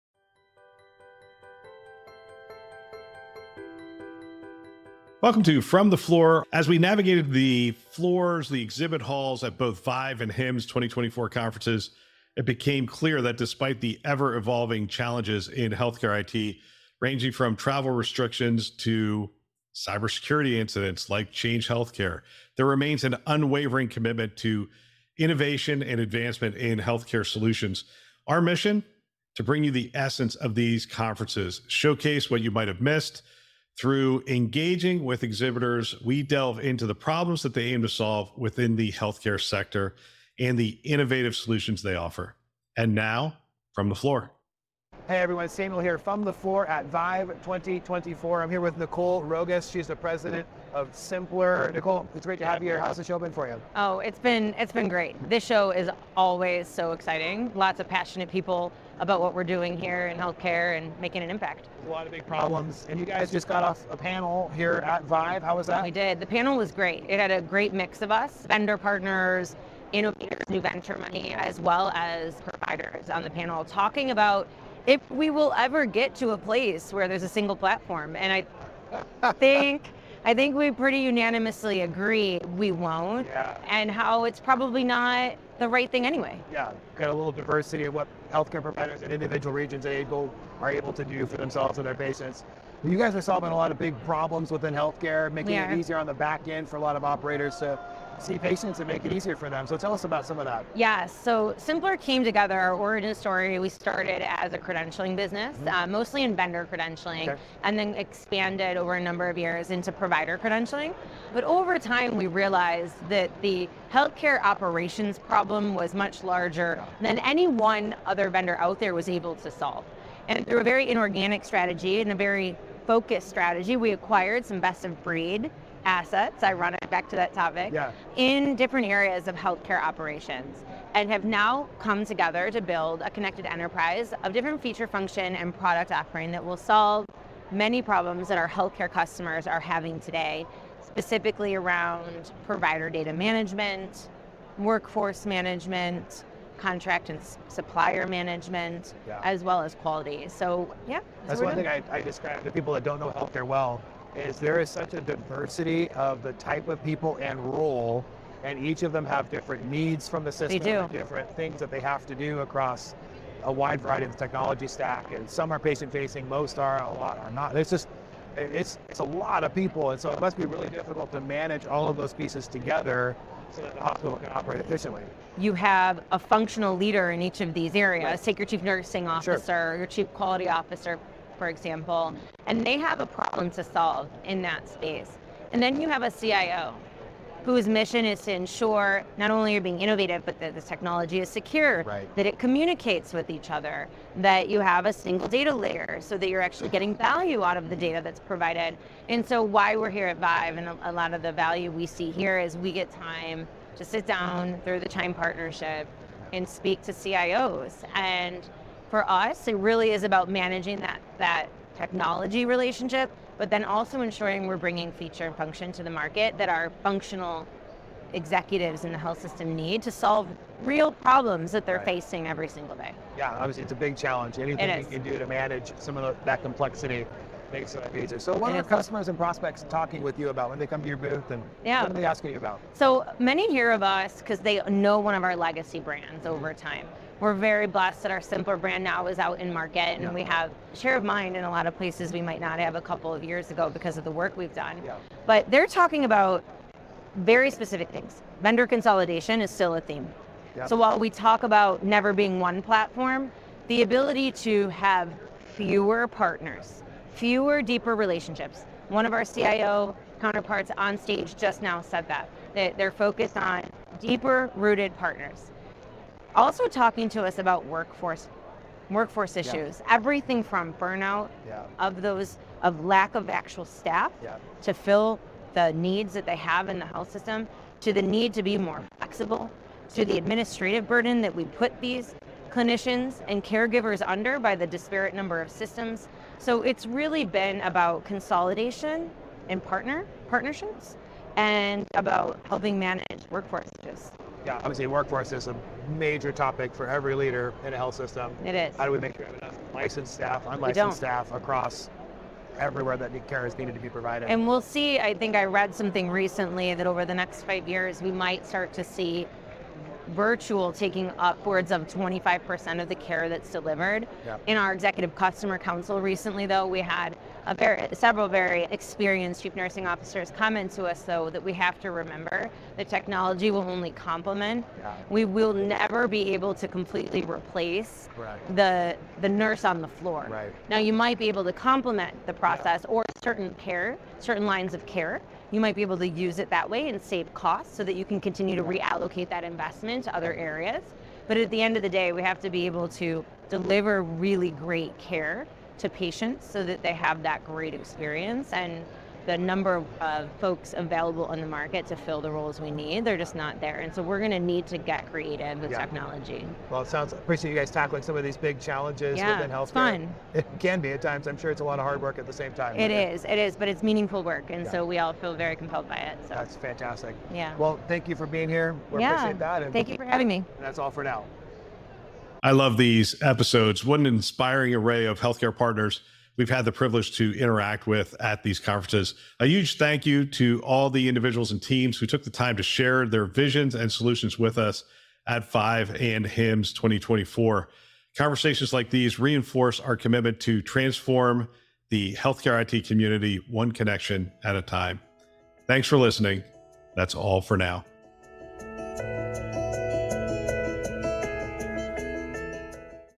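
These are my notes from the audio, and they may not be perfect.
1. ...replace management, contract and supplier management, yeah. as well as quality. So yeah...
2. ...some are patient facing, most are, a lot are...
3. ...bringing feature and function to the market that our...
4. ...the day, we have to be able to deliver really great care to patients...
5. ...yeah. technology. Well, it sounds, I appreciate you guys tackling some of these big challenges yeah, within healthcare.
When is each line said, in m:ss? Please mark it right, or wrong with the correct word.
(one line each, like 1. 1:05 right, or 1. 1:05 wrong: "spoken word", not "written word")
1. 2:24 wrong: "workforce", not "replace"
2. 2:45 right
3. 3:34 right
4. 5:41 right
5. 5:55 right.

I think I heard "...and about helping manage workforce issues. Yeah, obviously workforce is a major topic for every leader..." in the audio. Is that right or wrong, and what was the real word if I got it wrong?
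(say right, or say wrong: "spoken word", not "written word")
right.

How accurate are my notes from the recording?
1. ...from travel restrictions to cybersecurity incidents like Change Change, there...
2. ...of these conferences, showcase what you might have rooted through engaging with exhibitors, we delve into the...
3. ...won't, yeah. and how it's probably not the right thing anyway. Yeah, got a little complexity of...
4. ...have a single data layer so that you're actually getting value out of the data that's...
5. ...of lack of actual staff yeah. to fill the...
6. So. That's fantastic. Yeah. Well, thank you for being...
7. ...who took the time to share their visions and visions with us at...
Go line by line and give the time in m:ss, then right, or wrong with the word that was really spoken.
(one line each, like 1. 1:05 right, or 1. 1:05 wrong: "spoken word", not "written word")
1. 0:17 wrong: "Healthcare", not "Change"
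2. 0:30 wrong: "missed", not "rooted"
3. 1:22 wrong: "diversity", not "complexity"
4. 3:14 right
5. 4:32 right
6. 6:06 right
7. 6:21 wrong: "solutions", not "visions".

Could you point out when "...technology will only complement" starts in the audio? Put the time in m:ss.
5:22.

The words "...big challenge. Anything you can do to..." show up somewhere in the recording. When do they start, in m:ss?
3:43.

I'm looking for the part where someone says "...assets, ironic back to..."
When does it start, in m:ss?
2:05.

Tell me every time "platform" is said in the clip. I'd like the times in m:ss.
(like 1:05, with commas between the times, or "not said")
1:17, 4:12.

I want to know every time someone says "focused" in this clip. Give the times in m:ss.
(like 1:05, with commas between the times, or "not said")
2:02, 4:22.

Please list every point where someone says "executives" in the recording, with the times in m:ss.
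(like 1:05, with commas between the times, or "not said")
3:38, 5:14.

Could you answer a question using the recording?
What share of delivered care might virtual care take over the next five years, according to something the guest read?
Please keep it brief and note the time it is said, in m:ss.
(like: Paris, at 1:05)
25%, at 5:11.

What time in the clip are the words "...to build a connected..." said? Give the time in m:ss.
2:12.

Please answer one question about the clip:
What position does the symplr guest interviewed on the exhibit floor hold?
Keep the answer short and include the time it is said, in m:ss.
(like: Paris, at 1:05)
President, at 0:49.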